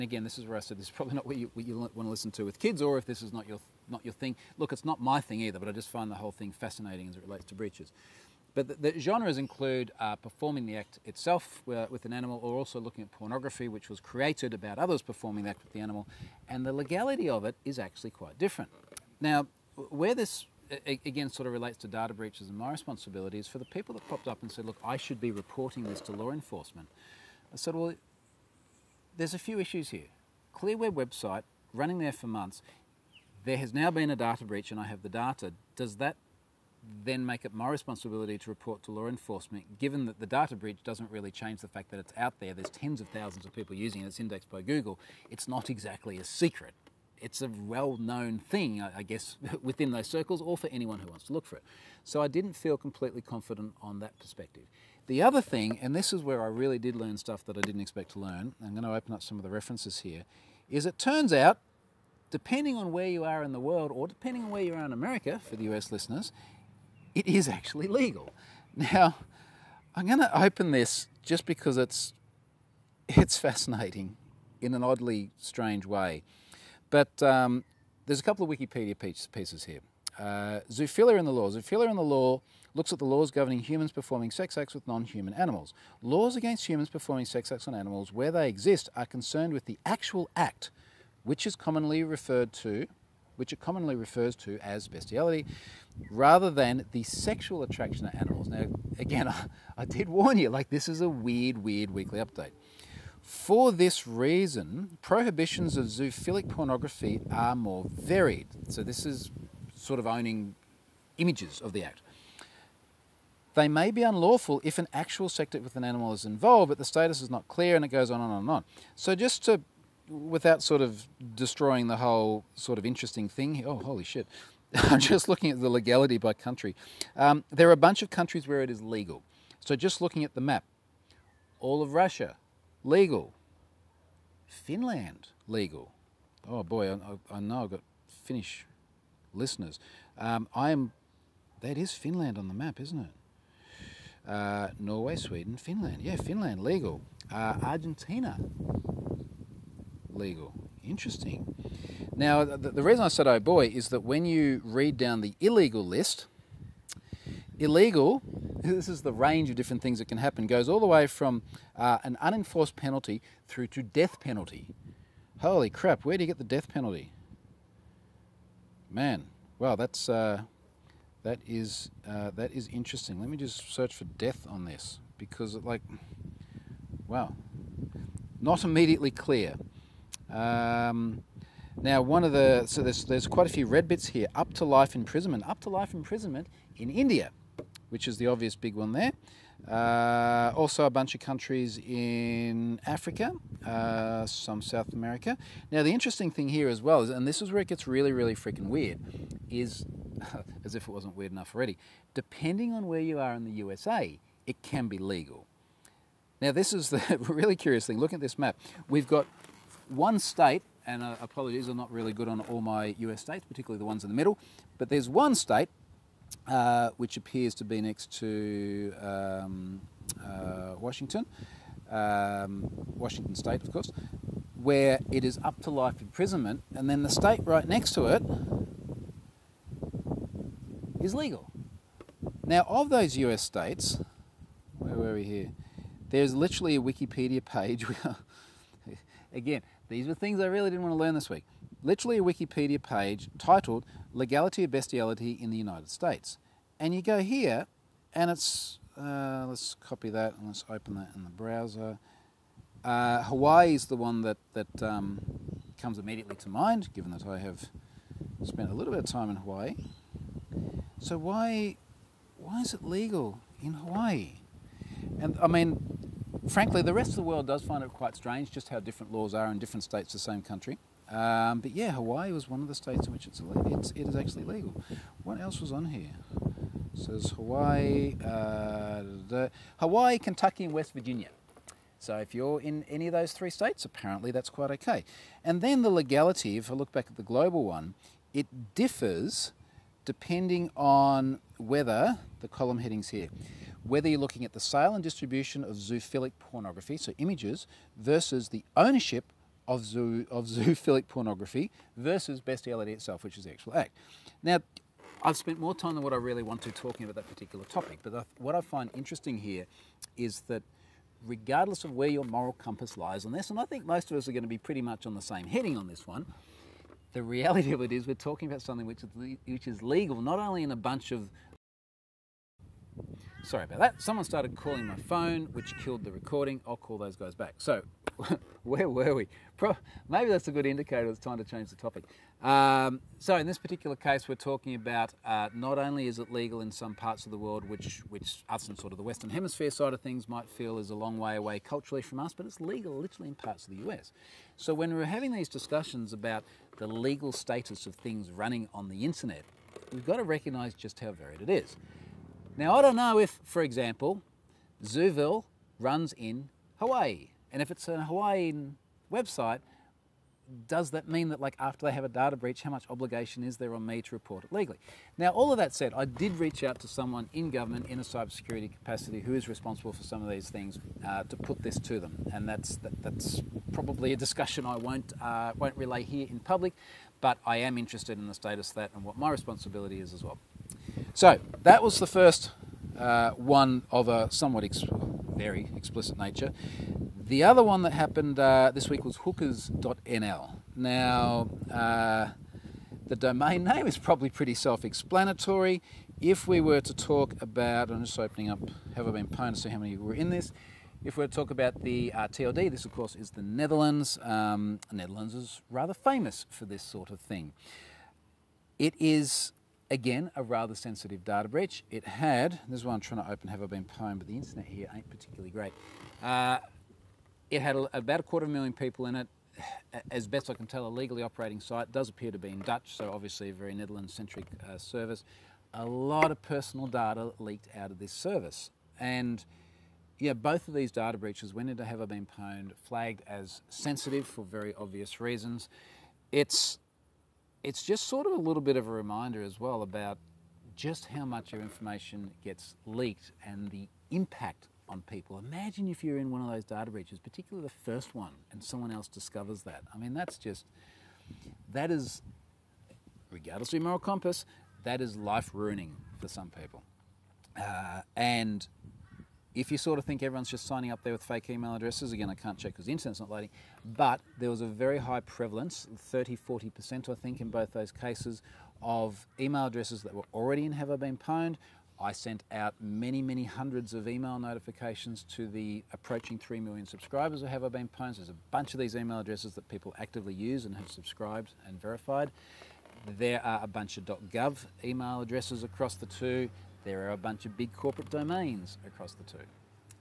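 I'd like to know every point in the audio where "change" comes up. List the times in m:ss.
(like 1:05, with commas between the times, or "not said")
0:41, 5:31.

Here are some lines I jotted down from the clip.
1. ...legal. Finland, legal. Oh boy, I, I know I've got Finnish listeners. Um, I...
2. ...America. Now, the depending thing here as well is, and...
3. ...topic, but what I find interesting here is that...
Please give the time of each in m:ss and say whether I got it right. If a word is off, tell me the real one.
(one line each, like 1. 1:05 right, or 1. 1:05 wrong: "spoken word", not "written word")
1. 2:12 right
2. 3:14 wrong: "interesting", not "depending"
3. 5:07 right.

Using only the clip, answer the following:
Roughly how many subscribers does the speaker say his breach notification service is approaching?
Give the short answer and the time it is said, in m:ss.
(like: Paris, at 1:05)
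3 million, at 7:56.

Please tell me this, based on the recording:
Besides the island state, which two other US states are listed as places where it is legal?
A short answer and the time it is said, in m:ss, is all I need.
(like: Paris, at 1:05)
Kentucky and West Virginia, at 4:40.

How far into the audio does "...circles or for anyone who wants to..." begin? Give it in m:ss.
0:50.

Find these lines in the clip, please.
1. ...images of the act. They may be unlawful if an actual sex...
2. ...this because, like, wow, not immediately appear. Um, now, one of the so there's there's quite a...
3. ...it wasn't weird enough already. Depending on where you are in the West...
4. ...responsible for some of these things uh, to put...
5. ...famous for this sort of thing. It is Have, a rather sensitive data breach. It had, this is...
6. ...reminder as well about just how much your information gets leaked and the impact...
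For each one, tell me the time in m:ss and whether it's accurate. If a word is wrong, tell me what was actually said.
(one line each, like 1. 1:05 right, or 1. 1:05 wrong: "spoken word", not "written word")
1. 1:51 right
2. 2:54 wrong: "clear", not "appear"
3. 3:20 wrong: "USA", not "West"
4. 6:09 right
5. 6:45 wrong: "Again", not "Have"
6. 7:18 right.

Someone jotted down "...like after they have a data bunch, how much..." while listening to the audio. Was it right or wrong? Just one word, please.
wrong.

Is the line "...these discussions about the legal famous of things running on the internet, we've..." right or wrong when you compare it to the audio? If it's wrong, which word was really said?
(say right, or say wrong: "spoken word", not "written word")
wrong: "status", not "famous".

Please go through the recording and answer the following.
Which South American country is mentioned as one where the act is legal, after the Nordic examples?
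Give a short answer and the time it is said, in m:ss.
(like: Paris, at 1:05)
Argentina, at 2:27.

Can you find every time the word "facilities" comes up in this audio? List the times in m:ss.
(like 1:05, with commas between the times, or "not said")
not said.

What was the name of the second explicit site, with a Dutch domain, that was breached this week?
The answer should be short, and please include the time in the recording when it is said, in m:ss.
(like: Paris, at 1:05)
hookers.nl, at 6:29.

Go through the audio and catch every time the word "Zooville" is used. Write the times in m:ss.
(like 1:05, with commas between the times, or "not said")
5:54.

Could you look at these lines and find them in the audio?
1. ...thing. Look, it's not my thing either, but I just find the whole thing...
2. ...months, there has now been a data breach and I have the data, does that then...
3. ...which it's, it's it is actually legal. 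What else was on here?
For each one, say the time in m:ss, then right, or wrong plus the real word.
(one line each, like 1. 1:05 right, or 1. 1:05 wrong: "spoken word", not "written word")
1. 0:04 right
2. 0:32 right
3. 4:33 right.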